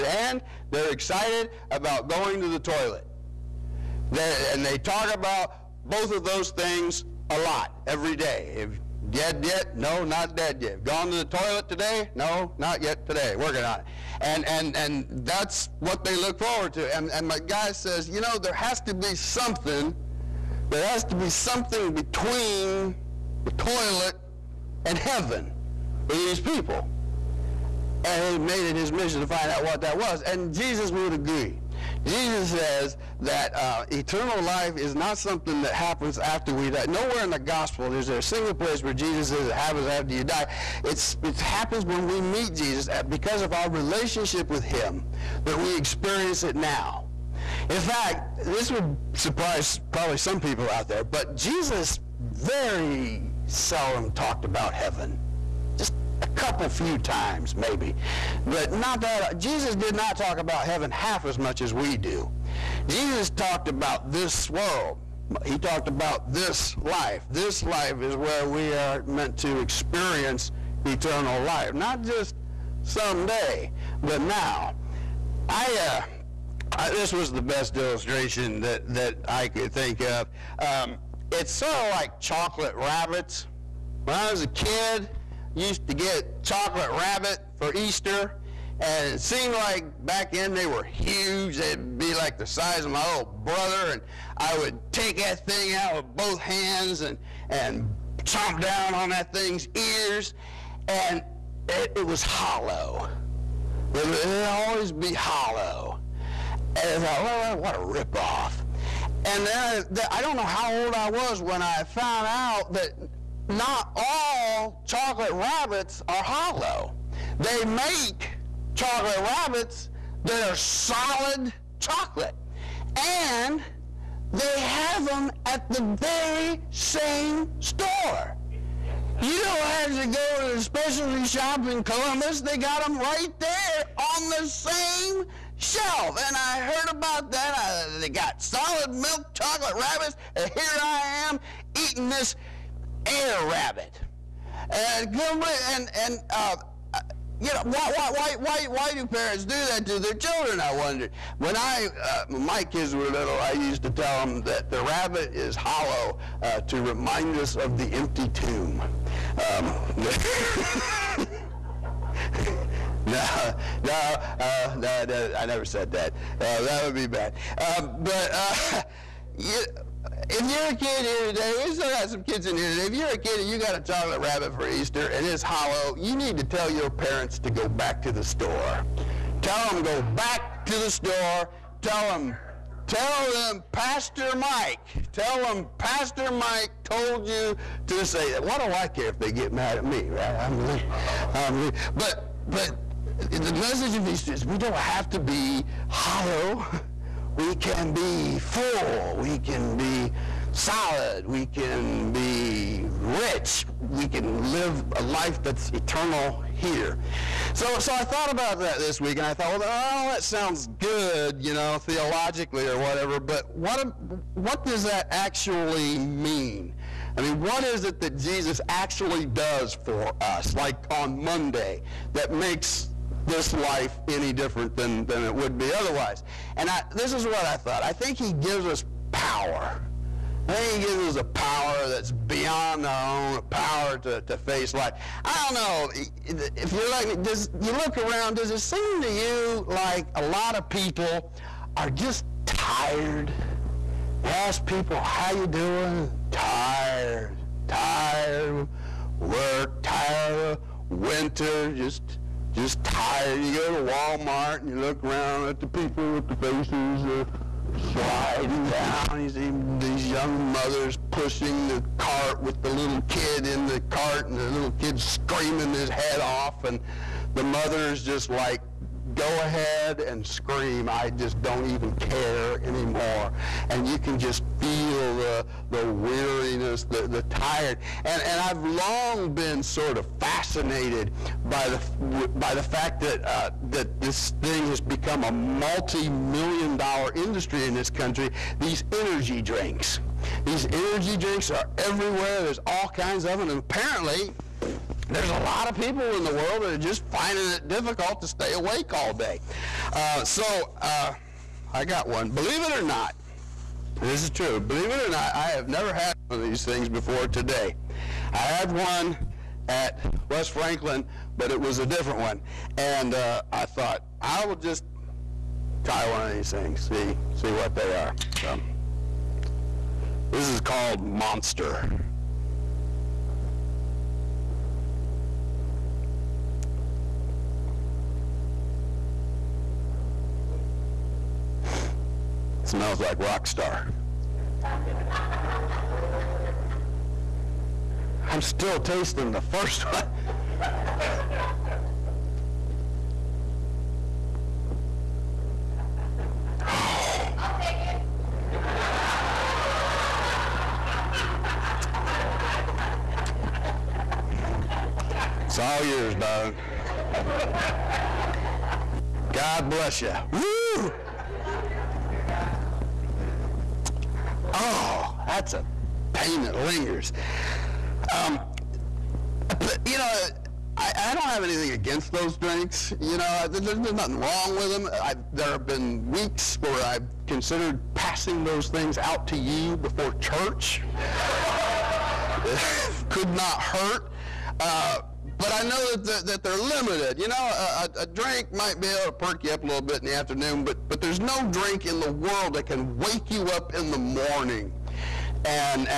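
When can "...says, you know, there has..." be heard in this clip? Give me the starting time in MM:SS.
00:17.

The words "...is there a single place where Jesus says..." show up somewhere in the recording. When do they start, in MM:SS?
00:37.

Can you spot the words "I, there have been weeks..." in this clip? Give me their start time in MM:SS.
06:15.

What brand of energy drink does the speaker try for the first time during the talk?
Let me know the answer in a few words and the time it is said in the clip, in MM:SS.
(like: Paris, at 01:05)
Monster, at 05:21.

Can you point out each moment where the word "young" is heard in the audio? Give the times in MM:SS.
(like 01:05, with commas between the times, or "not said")
04:20.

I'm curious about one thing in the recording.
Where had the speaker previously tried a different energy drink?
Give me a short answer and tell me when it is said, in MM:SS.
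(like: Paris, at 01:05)
West Franklin, at 05:10.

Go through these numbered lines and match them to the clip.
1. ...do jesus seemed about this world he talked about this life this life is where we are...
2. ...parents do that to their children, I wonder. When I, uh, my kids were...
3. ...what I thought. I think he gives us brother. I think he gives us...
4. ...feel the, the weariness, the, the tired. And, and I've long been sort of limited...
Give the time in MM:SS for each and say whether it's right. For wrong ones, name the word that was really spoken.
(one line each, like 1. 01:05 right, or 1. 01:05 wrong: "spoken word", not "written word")
1. 01:01 wrong: "talked", not "seemed"
2. 02:29 right
3. 03:47 wrong: "power", not "brother"
4. 04:34 wrong: "fascinated", not "limited".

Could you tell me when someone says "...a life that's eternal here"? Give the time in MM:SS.
03:24.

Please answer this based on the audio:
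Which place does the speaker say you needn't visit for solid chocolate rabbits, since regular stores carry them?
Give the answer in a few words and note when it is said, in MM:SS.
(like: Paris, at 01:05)
Columbus, at 02:11.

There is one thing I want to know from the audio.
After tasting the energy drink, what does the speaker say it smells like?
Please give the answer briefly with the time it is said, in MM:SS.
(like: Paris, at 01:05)
rock star, at 05:33.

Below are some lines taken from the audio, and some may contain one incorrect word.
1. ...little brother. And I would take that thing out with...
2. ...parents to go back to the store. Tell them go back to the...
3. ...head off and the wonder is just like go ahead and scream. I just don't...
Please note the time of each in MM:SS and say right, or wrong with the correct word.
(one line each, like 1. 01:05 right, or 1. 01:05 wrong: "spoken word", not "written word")
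1. 01:33 right
2. 02:56 right
3. 04:25 wrong: "mother", not "wonder".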